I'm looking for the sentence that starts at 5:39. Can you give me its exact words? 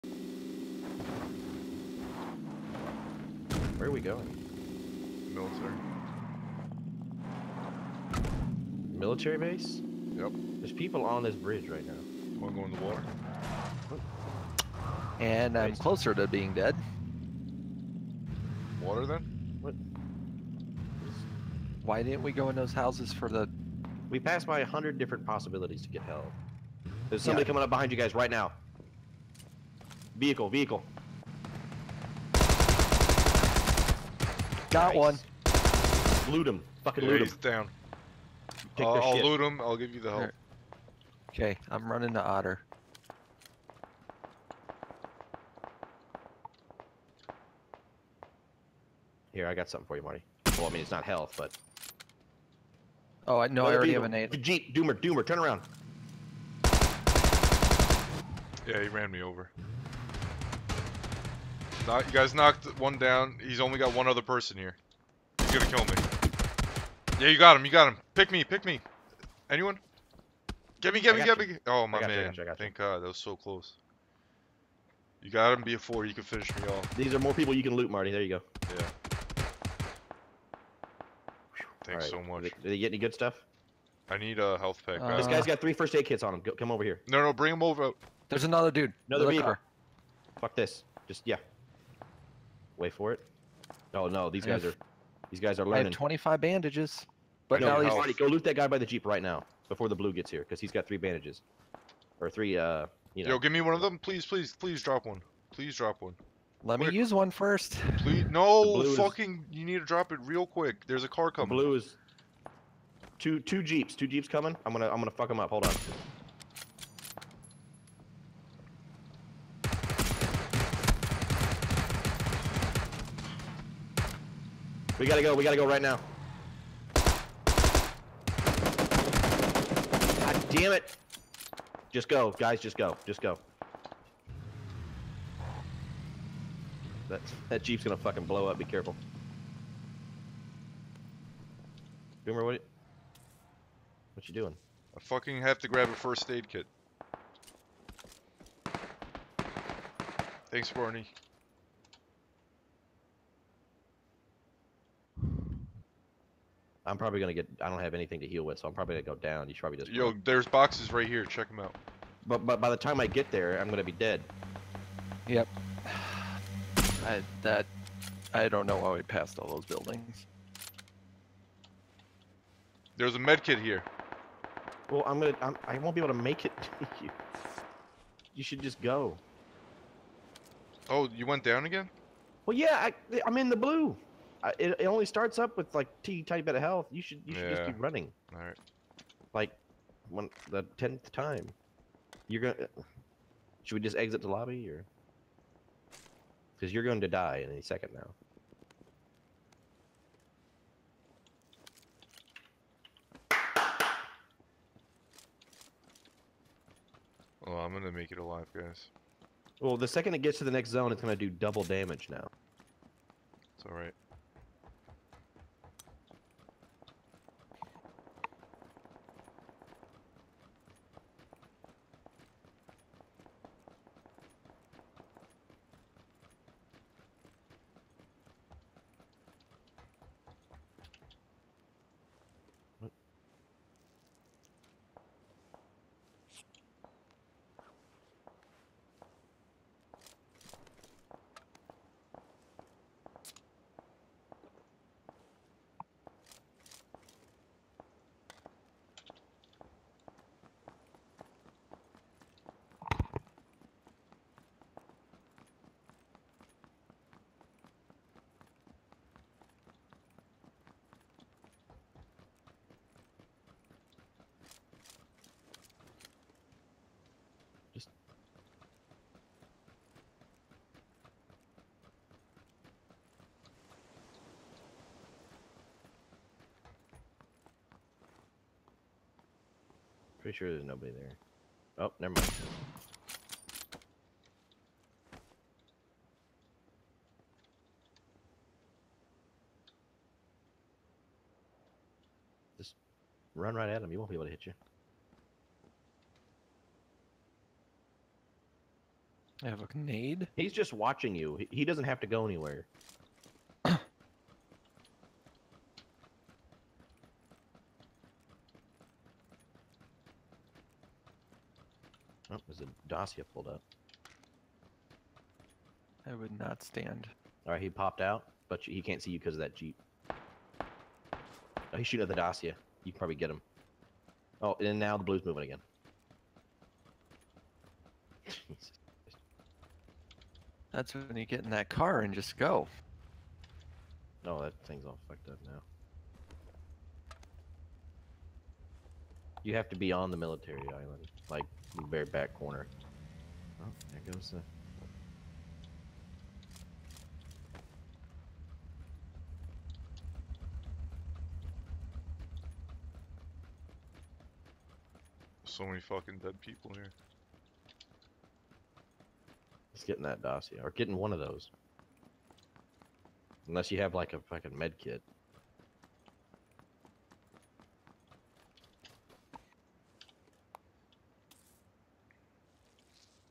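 You have to be on the military island, like the very back corner.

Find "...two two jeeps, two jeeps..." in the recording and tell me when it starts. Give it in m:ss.
1:53.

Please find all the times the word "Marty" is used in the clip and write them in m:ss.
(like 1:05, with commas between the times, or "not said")
0:50, 1:17.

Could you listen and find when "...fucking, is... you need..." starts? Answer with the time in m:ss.
1:48.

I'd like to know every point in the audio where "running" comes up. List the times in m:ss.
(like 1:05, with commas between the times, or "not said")
0:41, 3:07.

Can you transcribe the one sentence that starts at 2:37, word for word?
I don't have anything to heal with, so I'm probably gonna go down.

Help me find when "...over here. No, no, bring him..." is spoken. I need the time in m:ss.
1:26.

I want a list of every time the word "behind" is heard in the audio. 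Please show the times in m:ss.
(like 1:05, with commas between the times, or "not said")
0:27.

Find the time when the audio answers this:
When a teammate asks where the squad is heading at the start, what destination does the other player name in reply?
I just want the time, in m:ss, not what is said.
0:08.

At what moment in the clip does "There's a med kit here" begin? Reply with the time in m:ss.
2:52.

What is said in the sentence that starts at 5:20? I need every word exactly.
Oh, he's shooting at the Dacia.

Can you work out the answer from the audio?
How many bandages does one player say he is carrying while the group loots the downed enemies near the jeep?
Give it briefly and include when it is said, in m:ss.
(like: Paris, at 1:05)
25, at 1:35.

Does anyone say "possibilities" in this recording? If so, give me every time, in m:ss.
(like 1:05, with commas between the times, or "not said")
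0:25.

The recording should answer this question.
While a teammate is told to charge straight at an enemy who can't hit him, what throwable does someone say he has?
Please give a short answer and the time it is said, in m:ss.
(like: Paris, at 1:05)
A grenade, at 4:59.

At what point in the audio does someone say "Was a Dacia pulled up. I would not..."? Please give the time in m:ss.
5:12.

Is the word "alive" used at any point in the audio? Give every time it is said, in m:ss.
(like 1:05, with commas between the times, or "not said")
3:28.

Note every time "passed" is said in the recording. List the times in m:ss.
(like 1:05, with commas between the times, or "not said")
0:24, 2:49.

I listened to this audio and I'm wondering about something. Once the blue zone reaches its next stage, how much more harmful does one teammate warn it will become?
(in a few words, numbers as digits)
double damage.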